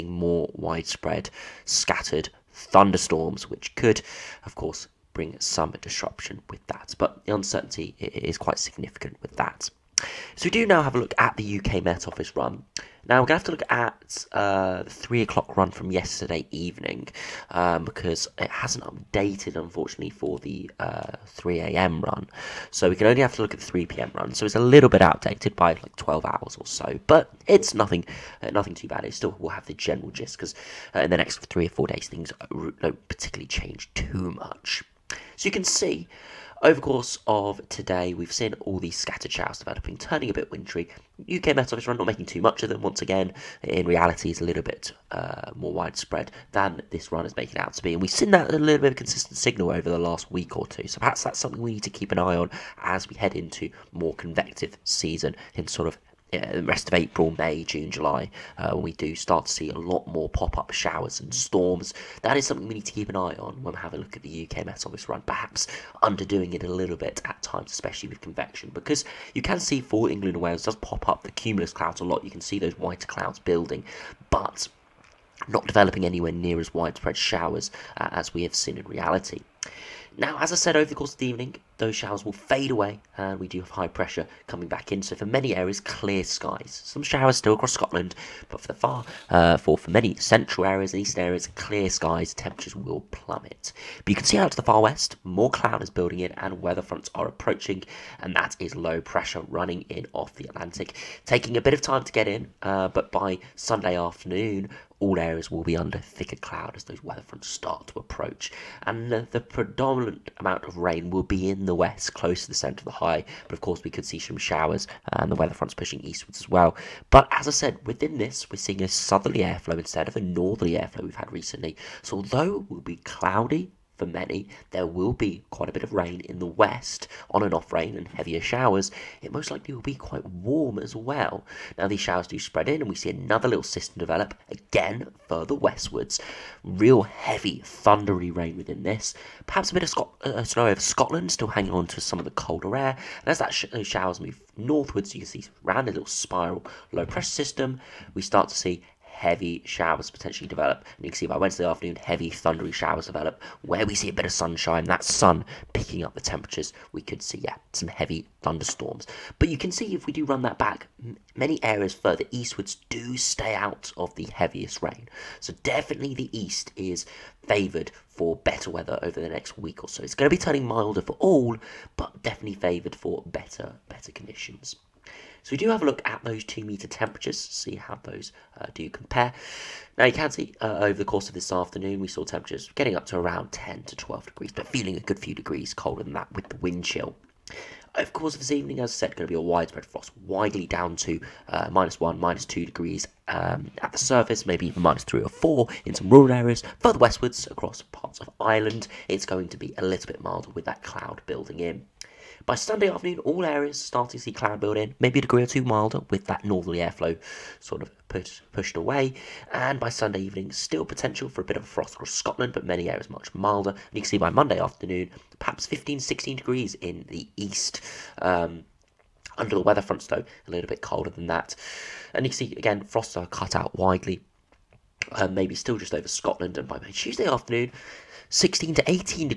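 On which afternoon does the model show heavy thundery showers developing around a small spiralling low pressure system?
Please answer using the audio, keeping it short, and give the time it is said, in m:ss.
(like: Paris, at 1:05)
Wednesday, at 2:31.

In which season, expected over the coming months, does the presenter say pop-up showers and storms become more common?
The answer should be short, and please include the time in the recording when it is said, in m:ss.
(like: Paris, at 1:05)
convective season, at 0:54.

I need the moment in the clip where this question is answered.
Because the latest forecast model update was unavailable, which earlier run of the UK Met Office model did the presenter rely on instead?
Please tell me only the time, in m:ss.
0:23.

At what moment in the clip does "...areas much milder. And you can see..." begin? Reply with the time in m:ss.
3:32.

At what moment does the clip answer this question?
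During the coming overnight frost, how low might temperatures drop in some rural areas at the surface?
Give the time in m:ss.
3:14.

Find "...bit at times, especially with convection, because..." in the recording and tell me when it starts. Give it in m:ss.
1:06.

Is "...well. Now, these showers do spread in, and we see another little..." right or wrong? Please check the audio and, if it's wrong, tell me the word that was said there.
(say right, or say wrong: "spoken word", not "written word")
right.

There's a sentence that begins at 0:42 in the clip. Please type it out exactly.
Once again, in reality, it's a little bit uh, more widespread than this run is making out to be.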